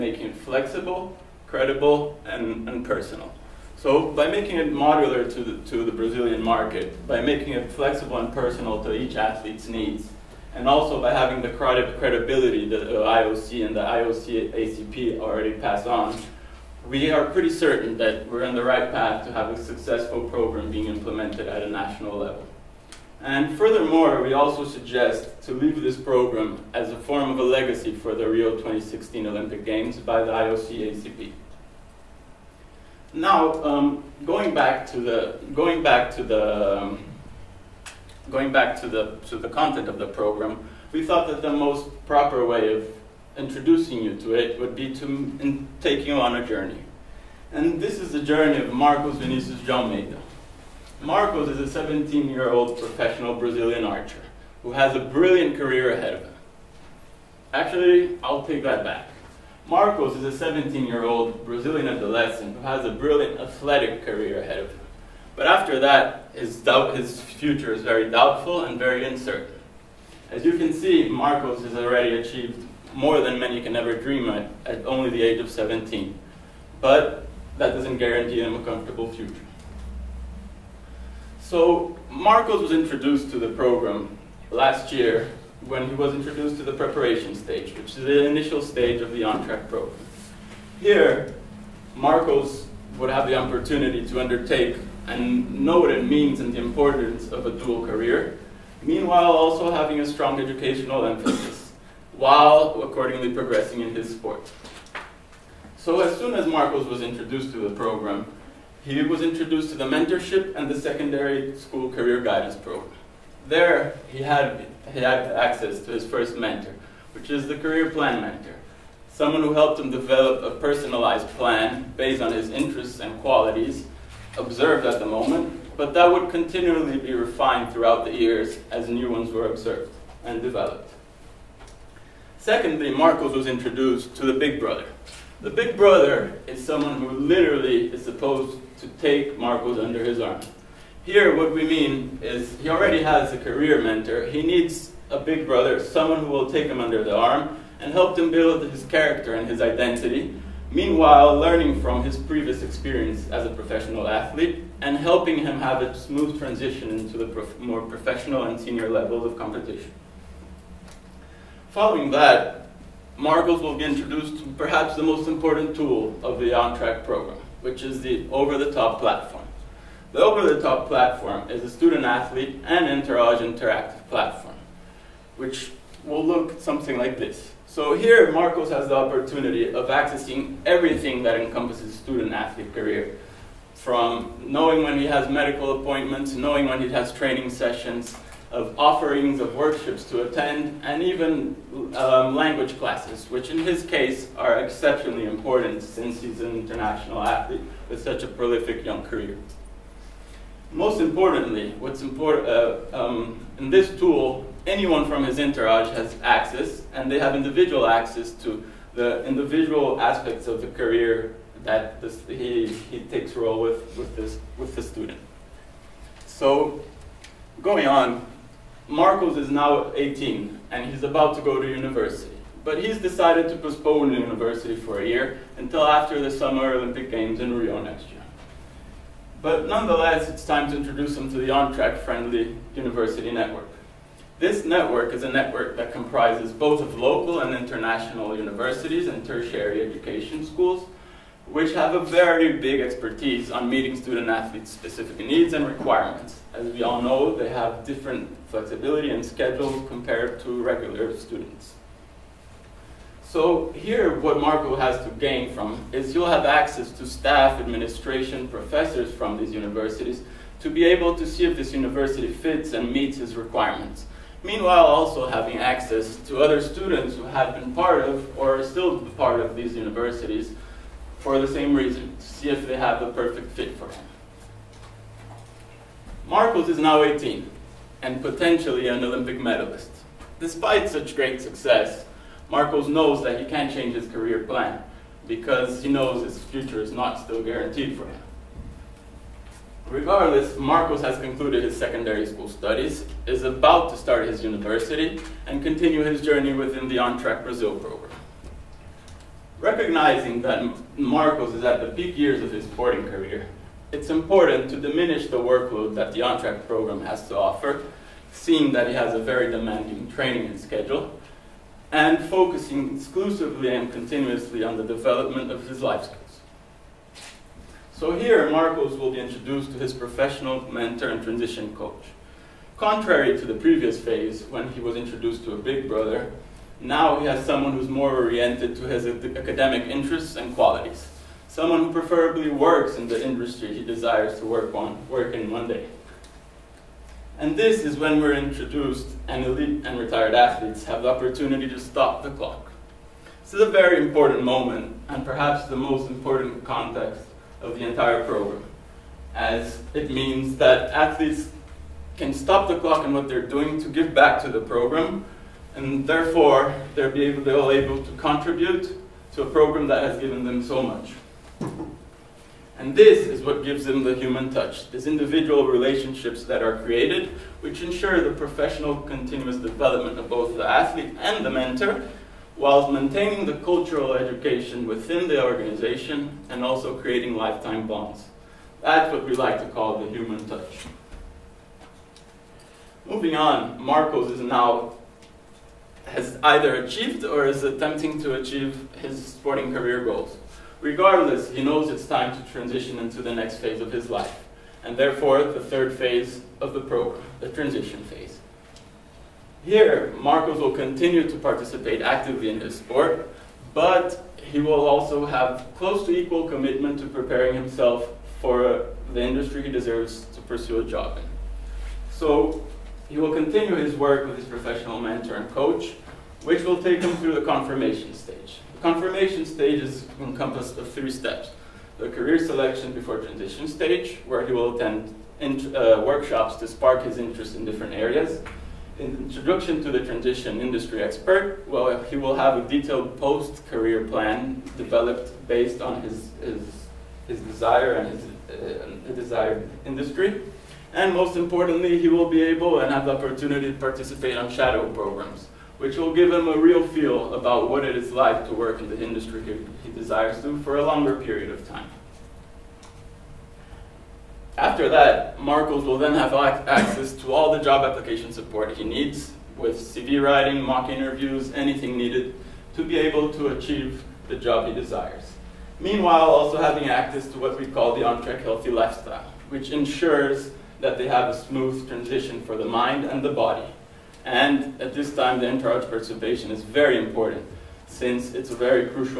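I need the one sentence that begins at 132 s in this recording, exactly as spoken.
Secondly, Marcos was introduced to the Big Brother.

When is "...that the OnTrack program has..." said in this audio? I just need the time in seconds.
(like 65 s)
305 s.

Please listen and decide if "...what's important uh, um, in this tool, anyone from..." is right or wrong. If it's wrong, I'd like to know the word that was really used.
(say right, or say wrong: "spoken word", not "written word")
right.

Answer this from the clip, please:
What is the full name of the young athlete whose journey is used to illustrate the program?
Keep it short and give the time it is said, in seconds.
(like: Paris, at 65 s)
Marcos Vinicius de Almeida, at 48 s.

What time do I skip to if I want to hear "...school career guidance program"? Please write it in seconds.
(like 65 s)
111 s.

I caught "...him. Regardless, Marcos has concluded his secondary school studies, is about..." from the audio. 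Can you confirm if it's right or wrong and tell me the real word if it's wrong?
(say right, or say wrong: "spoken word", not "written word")
right.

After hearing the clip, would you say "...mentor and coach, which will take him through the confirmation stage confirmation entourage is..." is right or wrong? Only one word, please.
wrong.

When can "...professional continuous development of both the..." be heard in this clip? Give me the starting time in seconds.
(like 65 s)
368 s.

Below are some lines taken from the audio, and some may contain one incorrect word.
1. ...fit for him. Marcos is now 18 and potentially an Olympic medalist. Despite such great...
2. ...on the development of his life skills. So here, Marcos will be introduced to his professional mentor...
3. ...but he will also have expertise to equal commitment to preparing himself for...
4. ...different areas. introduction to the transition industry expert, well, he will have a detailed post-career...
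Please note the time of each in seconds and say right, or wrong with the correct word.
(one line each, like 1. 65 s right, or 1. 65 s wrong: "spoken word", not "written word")
1. 273 s right
2. 314 s right
3. 403 s wrong: "close", not "expertise"
4. 427 s right.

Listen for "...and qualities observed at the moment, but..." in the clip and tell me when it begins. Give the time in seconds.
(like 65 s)
122 s.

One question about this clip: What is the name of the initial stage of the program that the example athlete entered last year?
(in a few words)
Preparation stage.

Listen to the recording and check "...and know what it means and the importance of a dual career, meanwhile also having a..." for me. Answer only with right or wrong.
right.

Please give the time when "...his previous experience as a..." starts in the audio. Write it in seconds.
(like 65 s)
152 s.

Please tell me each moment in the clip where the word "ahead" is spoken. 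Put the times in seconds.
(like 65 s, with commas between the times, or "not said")
55 s, 64 s.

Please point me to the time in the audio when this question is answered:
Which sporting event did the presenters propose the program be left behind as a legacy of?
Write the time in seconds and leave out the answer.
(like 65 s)
28 s.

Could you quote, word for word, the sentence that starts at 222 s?
But he's decided to postpone university for a year until after the Summer Olympic Games in Rio next year.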